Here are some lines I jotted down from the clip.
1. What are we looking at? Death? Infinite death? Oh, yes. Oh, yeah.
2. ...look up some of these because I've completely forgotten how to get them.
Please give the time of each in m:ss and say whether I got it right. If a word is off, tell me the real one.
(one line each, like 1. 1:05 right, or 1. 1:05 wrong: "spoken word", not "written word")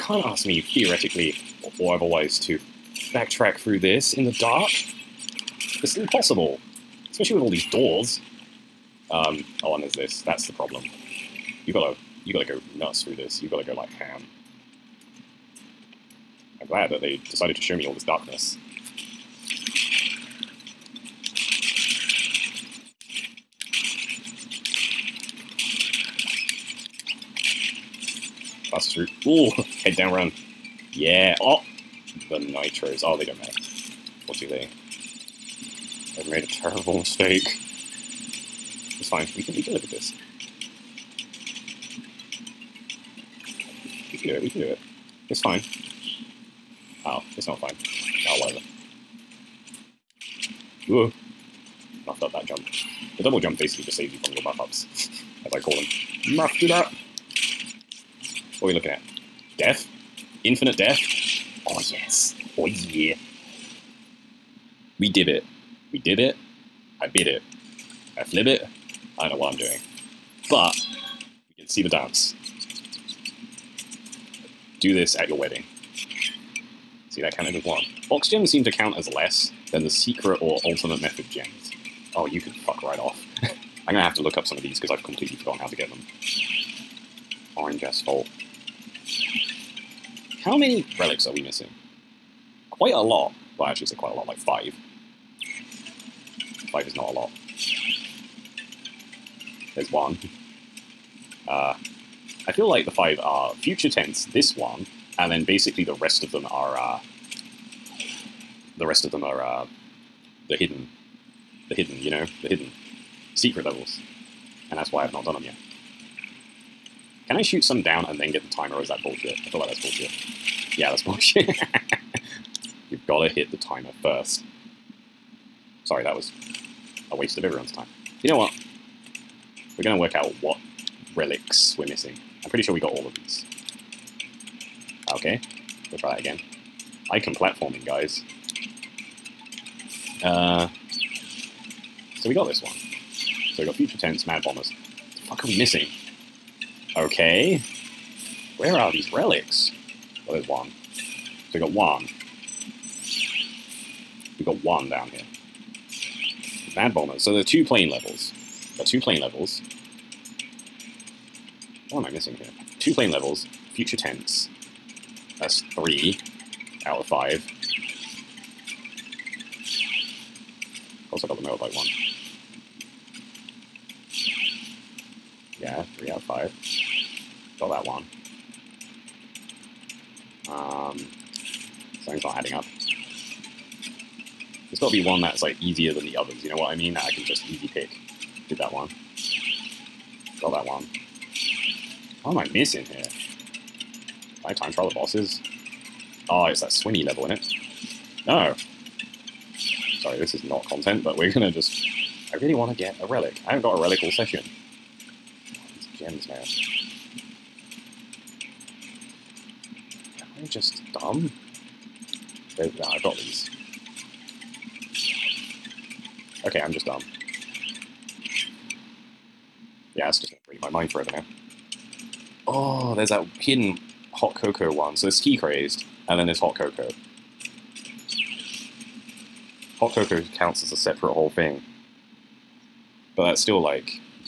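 1. 0:58 right
2. 1:24 right.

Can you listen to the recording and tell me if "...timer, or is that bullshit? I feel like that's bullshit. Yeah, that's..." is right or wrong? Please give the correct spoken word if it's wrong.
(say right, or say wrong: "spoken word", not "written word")
right.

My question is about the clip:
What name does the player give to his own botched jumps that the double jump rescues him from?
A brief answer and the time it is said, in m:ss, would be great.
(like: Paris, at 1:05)
muff ups, at 0:54.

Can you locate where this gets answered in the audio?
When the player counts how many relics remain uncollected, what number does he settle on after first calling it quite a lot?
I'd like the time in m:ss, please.
1:34.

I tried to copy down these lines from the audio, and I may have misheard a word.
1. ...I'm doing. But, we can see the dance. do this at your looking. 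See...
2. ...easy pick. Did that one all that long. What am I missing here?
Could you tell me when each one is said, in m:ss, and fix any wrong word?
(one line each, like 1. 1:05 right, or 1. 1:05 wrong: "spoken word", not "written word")
1. 1:09 wrong: "wedding", not "looking"
2. 3:07 right.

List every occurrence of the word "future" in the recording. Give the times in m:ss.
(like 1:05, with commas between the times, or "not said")
1:43, 2:23, 2:43.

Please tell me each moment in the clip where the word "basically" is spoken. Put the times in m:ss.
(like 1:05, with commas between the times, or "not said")
0:53, 1:45.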